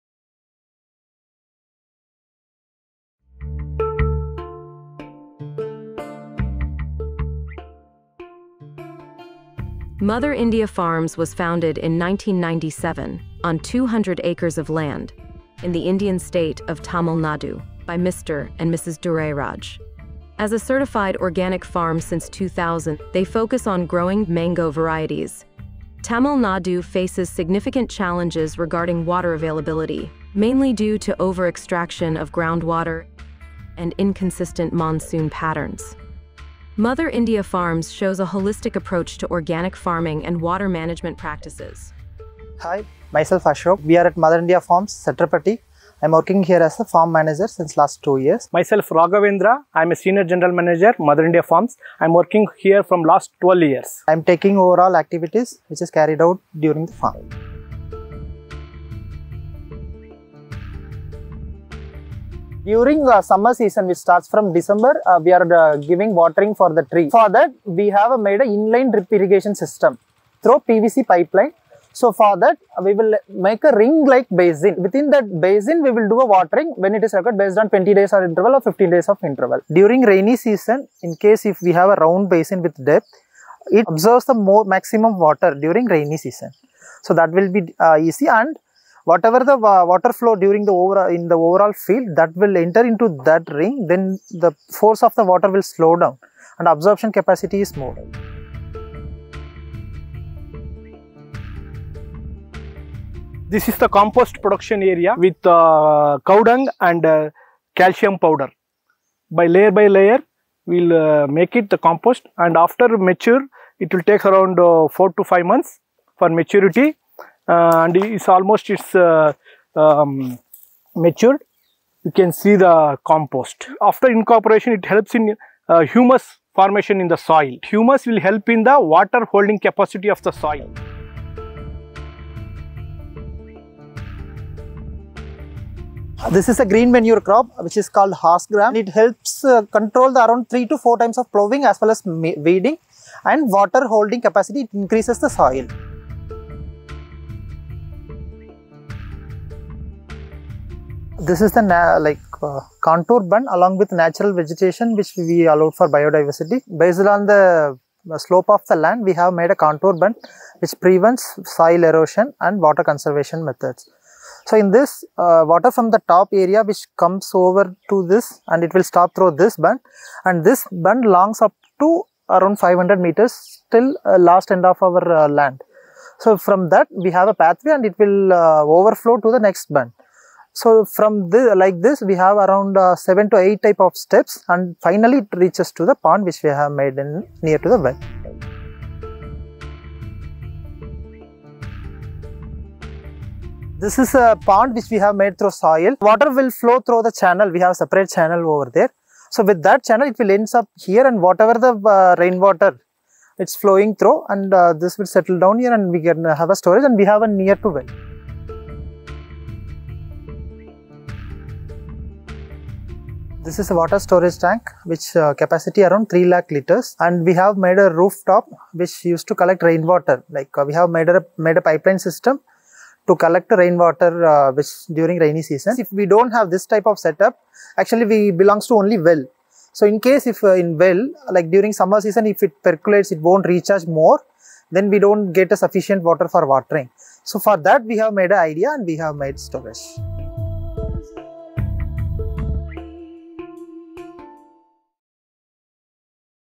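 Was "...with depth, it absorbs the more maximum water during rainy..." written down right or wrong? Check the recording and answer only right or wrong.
right.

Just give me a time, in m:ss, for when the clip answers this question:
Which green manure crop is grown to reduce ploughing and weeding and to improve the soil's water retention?
2:18.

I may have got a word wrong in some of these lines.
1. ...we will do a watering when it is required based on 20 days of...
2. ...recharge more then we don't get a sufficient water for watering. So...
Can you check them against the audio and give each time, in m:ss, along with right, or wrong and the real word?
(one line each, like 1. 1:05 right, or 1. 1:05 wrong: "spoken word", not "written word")
1. 1:15 right
2. 3:53 right.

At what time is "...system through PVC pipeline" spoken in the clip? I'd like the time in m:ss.
1:09.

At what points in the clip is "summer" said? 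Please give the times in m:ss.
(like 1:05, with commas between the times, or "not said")
1:03, 3:51.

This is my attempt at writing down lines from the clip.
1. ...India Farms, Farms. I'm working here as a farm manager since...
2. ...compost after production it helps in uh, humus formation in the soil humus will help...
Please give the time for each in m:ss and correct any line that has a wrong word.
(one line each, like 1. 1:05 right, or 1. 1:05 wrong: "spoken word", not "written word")
1. 0:44 wrong: "Satrapati", not "Farms"
2. 2:03 wrong: "incorporation", not "production".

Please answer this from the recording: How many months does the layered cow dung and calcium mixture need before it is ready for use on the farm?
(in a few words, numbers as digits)
4 to 5 months.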